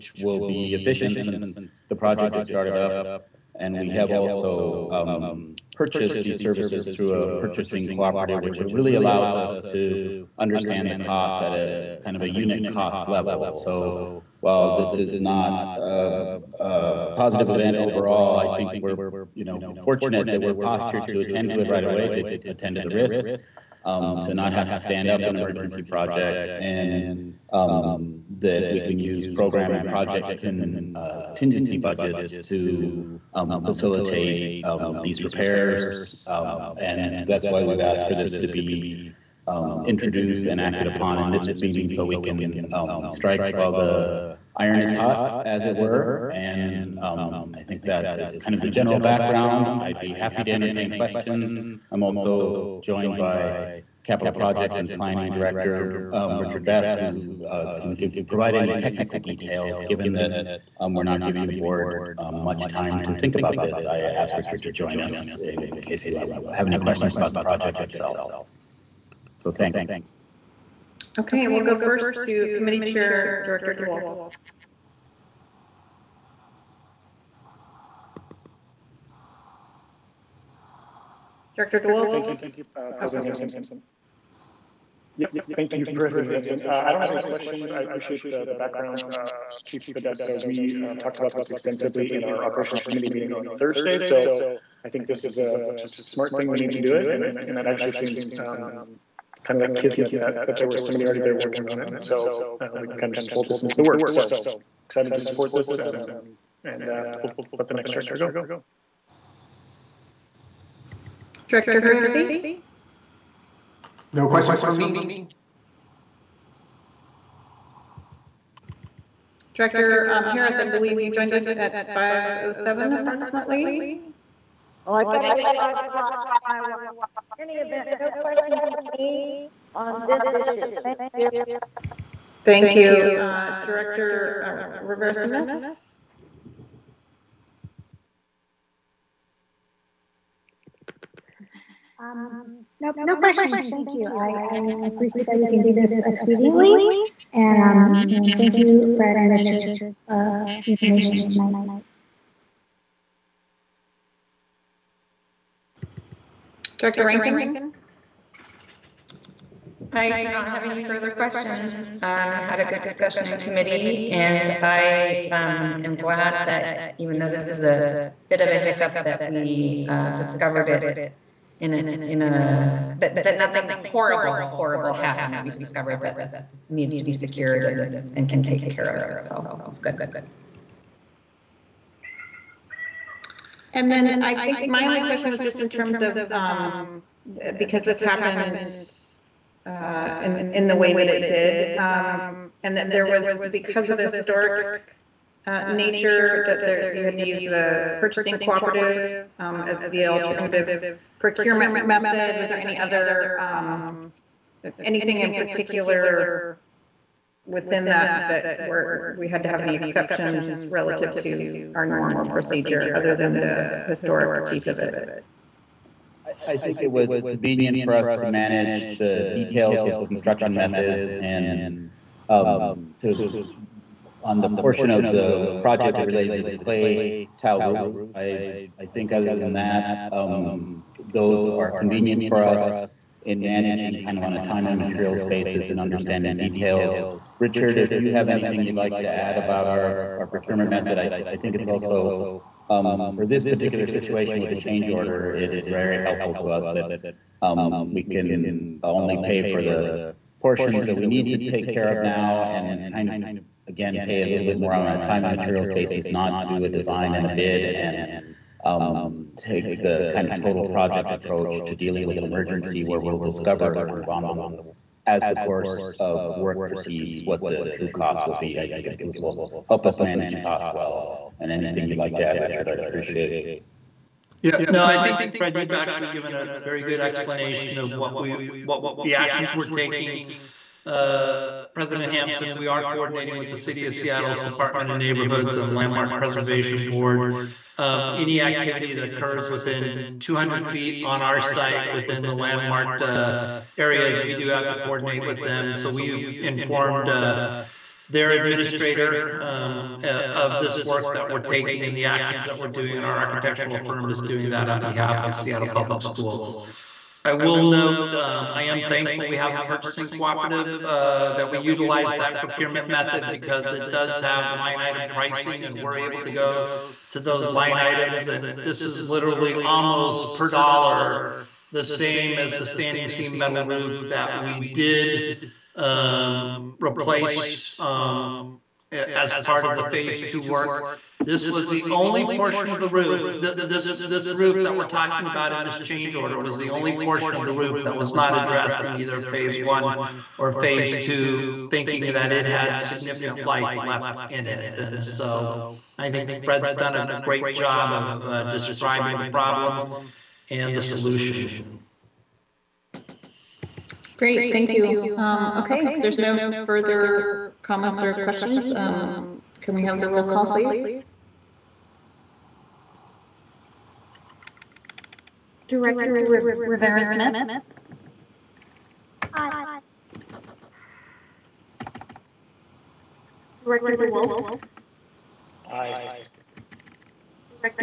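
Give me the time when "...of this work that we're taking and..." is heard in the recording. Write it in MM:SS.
05:00.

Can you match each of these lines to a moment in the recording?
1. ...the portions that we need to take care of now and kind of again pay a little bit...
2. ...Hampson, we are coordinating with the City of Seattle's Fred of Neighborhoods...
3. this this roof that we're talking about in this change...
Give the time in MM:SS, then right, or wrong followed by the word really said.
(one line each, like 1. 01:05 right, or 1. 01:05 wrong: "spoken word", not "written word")
1. 04:09 right
2. 04:42 wrong: "Department", not "Fred"
3. 05:33 right.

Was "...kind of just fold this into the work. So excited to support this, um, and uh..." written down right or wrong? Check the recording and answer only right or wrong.
right.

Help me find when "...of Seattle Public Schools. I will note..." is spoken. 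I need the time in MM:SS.
05:05.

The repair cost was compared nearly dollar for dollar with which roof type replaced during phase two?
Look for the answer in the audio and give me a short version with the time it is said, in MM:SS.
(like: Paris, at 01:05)
standing seam metal, at 05:22.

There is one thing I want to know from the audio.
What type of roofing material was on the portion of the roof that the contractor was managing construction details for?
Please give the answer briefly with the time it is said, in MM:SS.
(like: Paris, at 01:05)
clay tile, at 03:46.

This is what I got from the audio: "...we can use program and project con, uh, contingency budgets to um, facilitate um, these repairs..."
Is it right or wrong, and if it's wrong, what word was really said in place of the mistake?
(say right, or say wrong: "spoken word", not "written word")
right.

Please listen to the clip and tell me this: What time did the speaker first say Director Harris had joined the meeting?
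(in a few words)
5:07.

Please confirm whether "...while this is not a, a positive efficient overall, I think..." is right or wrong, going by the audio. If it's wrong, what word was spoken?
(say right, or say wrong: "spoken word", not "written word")
wrong: "event", not "efficient".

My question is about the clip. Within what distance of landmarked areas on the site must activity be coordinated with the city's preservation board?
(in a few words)
200 feet.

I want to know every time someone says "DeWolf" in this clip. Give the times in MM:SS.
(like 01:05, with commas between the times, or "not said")
01:13, 01:21, 06:13.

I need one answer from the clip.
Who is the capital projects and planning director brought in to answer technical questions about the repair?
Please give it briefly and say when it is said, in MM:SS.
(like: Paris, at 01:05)
Richard Best, at 00:56.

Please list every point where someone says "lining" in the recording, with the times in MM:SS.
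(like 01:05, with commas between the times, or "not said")
not said.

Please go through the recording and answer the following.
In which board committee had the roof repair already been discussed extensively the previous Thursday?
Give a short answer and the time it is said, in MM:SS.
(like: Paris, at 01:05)
Operations Committee, at 01:32.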